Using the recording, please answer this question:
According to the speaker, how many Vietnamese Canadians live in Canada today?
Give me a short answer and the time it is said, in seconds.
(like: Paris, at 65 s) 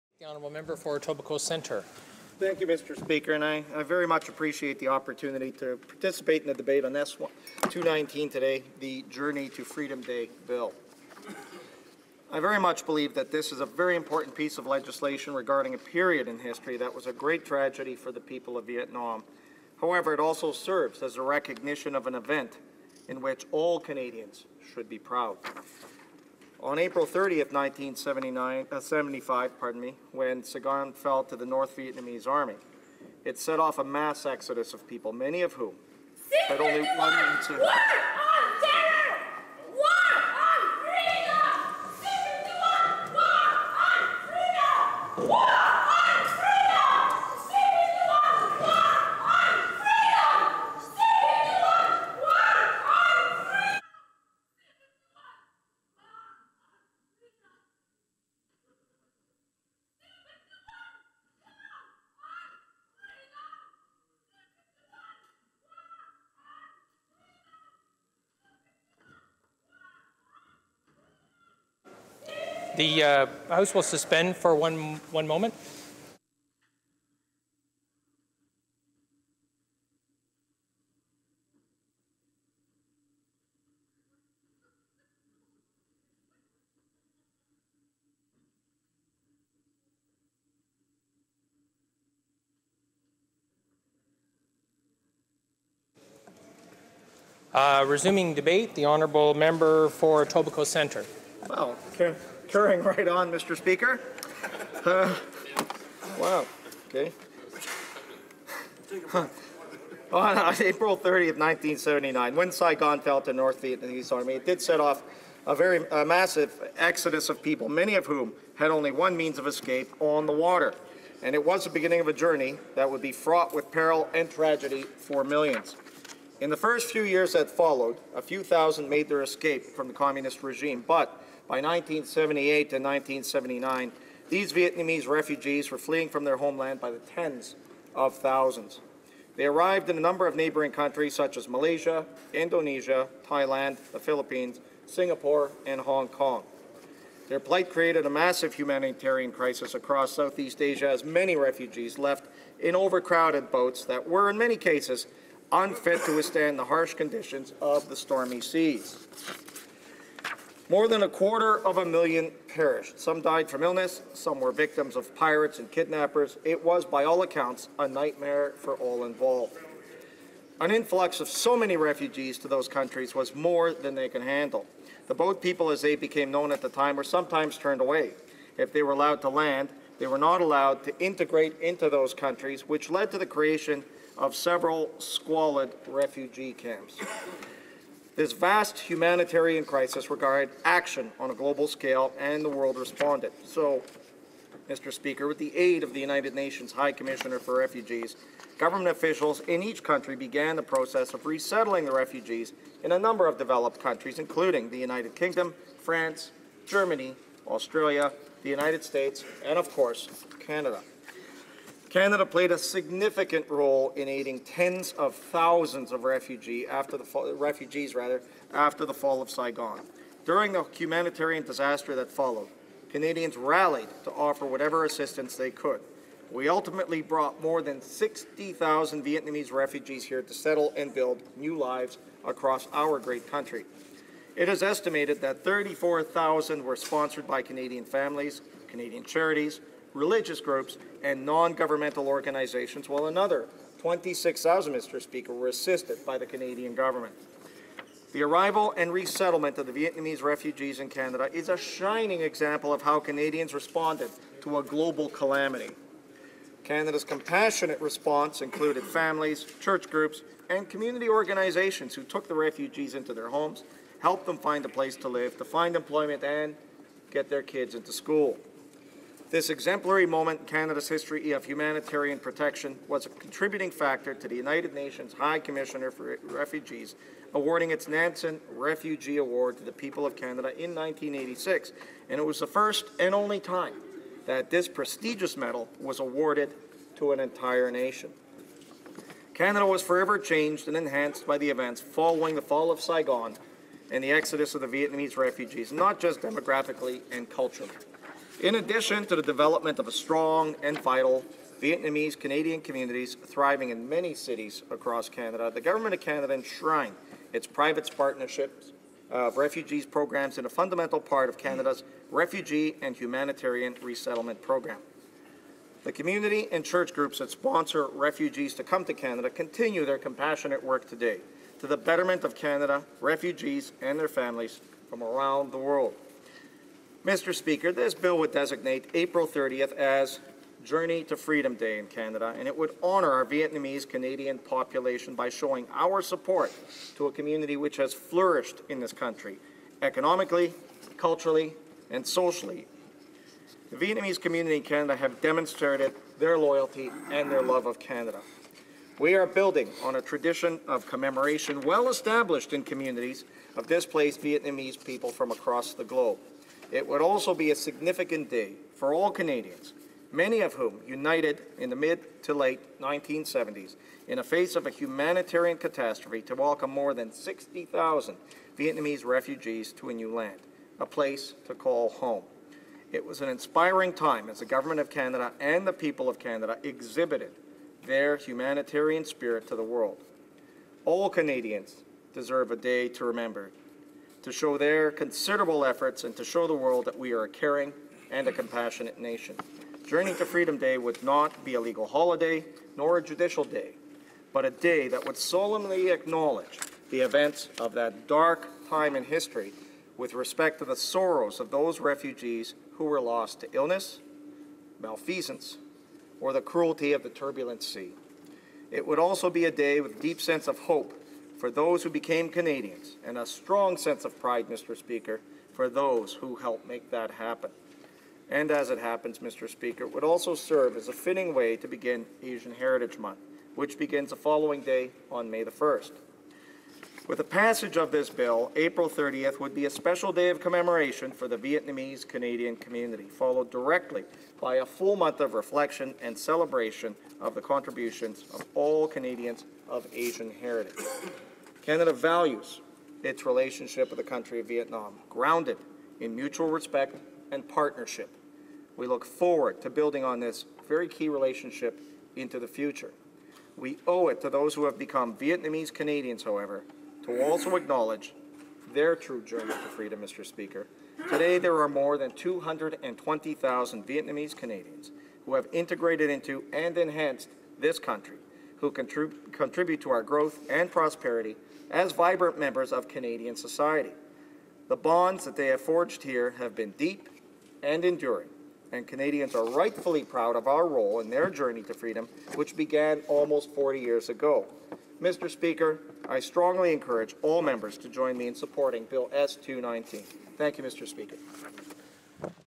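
more than 220,000, at 461 s.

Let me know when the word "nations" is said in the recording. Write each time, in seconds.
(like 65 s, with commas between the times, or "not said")
196 s, 274 s, 287 s, 388 s.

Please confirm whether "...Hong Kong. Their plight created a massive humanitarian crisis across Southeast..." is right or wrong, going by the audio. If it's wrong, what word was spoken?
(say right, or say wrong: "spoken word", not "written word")
right.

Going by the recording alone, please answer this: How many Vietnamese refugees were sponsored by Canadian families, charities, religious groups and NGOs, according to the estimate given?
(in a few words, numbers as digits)
34,000.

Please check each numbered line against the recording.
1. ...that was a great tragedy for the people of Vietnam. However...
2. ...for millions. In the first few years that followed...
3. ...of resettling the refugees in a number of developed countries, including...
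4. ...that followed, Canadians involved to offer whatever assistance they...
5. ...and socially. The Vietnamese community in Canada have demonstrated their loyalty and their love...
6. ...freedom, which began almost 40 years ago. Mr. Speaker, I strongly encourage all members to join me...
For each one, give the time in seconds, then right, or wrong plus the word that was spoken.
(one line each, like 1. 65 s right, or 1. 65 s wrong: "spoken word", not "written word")
1. 16 s right
2. 124 s right
3. 201 s right
4. 221 s wrong: "rallied", not "involved"
5. 341 s right
6. 481 s right.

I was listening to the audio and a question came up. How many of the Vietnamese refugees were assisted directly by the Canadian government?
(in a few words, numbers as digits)
26,000.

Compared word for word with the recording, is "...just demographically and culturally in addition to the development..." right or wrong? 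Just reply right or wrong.
right.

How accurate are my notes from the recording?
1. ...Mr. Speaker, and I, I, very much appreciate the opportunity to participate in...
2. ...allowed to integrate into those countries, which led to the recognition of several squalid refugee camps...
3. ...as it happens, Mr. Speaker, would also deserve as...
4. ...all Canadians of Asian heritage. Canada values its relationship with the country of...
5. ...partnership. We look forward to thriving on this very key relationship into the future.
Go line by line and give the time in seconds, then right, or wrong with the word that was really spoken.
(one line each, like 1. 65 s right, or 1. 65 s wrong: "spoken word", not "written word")
1. 2 s right
2. 180 s wrong: "creation", not "recognition"
3. 418 s wrong: "serve", not "deserve"
4. 438 s right
5. 447 s wrong: "building", not "thriving".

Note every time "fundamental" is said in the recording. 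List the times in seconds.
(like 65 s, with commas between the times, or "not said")
310 s.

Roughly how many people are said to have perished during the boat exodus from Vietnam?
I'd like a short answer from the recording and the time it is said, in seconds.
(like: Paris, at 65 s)
more than a quarter of a million, at 160 s.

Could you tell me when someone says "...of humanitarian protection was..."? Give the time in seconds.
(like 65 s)
271 s.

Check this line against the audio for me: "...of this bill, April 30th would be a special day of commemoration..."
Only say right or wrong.
right.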